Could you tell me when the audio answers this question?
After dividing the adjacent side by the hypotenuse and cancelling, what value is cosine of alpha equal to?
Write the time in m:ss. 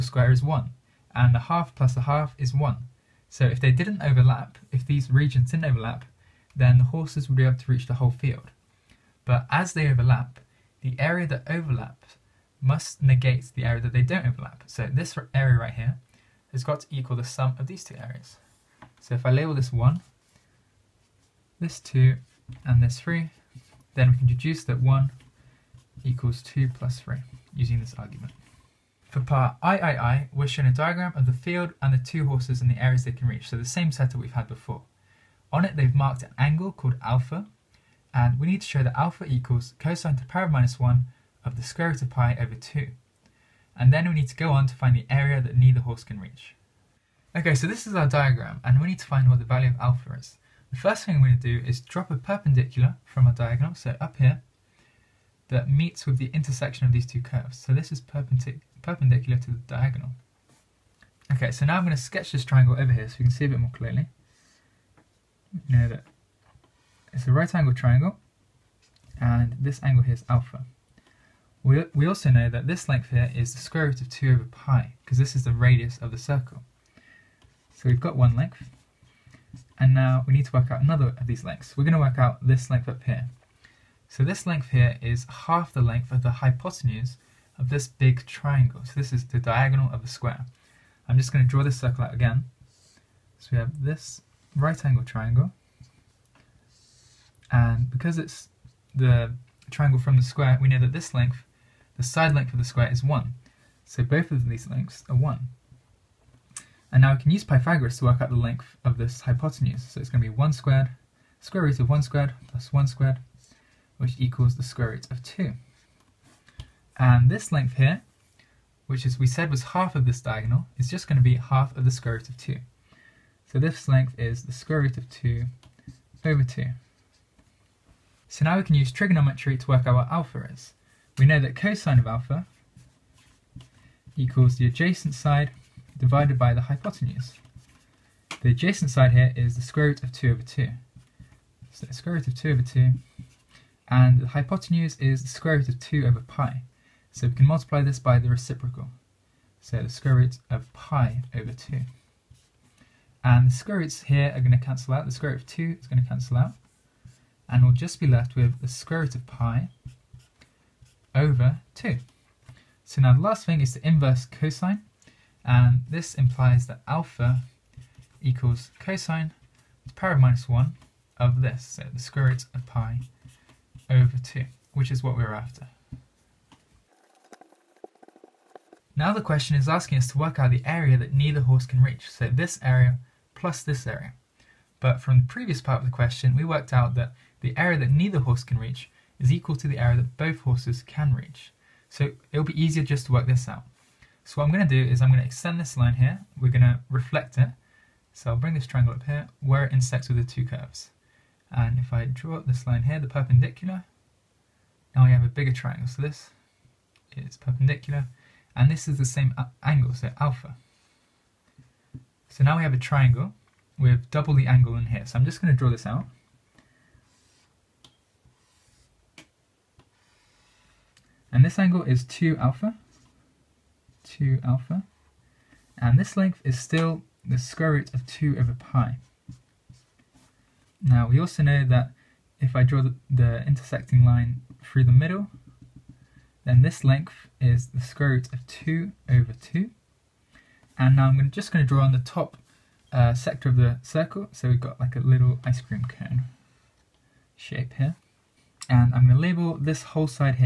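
2:37.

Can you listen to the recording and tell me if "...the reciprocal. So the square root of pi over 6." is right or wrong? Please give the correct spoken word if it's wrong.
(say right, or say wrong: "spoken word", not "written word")
wrong: "2", not "6".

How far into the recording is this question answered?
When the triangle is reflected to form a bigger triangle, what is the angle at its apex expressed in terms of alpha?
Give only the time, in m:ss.
3:41.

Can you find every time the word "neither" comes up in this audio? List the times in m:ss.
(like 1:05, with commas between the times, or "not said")
0:45, 3:01, 3:07.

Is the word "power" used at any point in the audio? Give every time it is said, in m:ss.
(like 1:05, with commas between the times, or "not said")
0:40, 2:49.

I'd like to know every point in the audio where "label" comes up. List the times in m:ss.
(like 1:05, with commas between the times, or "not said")
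0:19, 4:09.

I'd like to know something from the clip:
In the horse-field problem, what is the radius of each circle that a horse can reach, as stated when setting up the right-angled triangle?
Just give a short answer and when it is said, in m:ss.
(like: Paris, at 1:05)
square root of 2 over pi, at 1:13.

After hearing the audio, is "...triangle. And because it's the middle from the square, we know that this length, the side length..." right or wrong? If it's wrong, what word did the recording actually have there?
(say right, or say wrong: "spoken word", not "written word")
wrong: "triangle", not "middle".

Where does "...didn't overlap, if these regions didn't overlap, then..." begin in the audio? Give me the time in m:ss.
0:03.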